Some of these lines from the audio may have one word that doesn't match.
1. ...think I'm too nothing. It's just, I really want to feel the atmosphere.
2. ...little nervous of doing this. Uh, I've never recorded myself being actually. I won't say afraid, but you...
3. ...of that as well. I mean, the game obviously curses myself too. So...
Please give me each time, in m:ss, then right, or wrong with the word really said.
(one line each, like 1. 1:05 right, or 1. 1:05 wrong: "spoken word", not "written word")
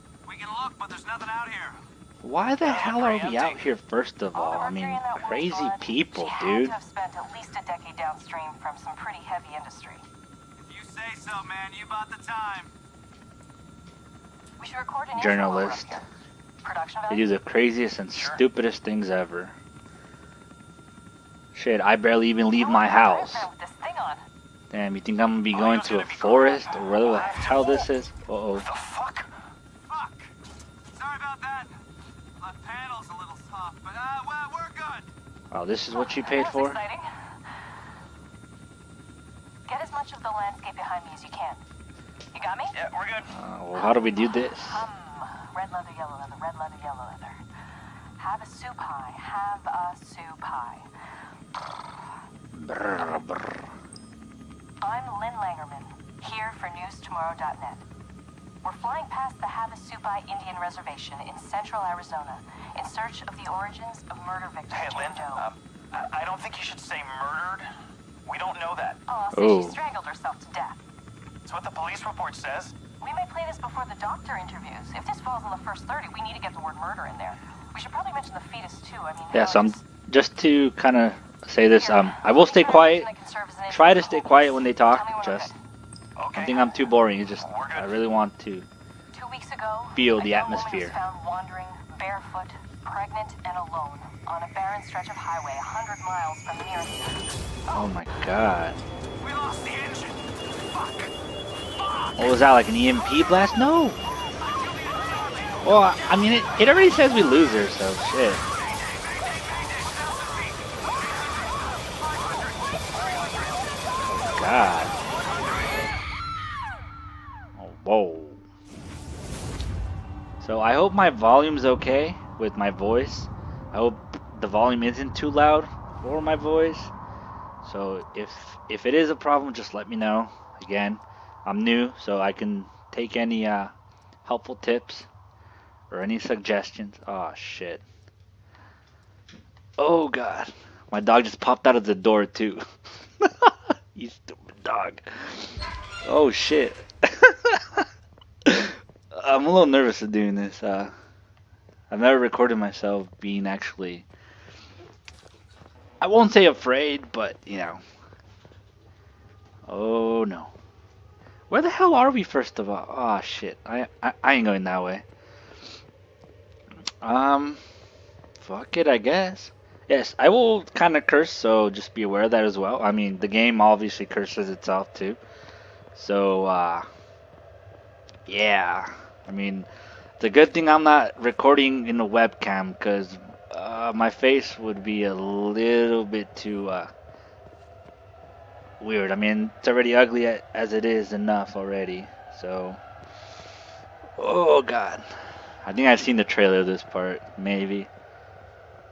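1. 1:26 wrong: "boring", not "nothing"
2. 2:29 right
3. 2:52 wrong: "itself", not "myself".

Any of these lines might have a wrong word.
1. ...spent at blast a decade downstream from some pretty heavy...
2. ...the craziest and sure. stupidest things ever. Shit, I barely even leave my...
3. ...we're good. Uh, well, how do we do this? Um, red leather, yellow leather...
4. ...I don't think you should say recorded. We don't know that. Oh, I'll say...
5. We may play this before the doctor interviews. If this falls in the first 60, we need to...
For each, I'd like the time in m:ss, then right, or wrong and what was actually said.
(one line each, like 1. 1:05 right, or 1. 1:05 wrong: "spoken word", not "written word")
1. 0:06 wrong: "least", not "blast"
2. 0:17 right
3. 0:42 right
4. 1:06 wrong: "murdered", not "recorded"
5. 1:13 wrong: "30", not "60".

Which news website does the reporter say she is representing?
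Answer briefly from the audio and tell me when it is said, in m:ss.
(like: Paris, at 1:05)
NewsTomorrow.net, at 0:56.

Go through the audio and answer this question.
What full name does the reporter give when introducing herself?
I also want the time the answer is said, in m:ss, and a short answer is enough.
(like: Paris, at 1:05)
Lynn Langermann, at 0:55.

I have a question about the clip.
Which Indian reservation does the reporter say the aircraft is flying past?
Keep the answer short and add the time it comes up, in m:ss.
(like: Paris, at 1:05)
Havasupai Indian Reservation, at 0:59.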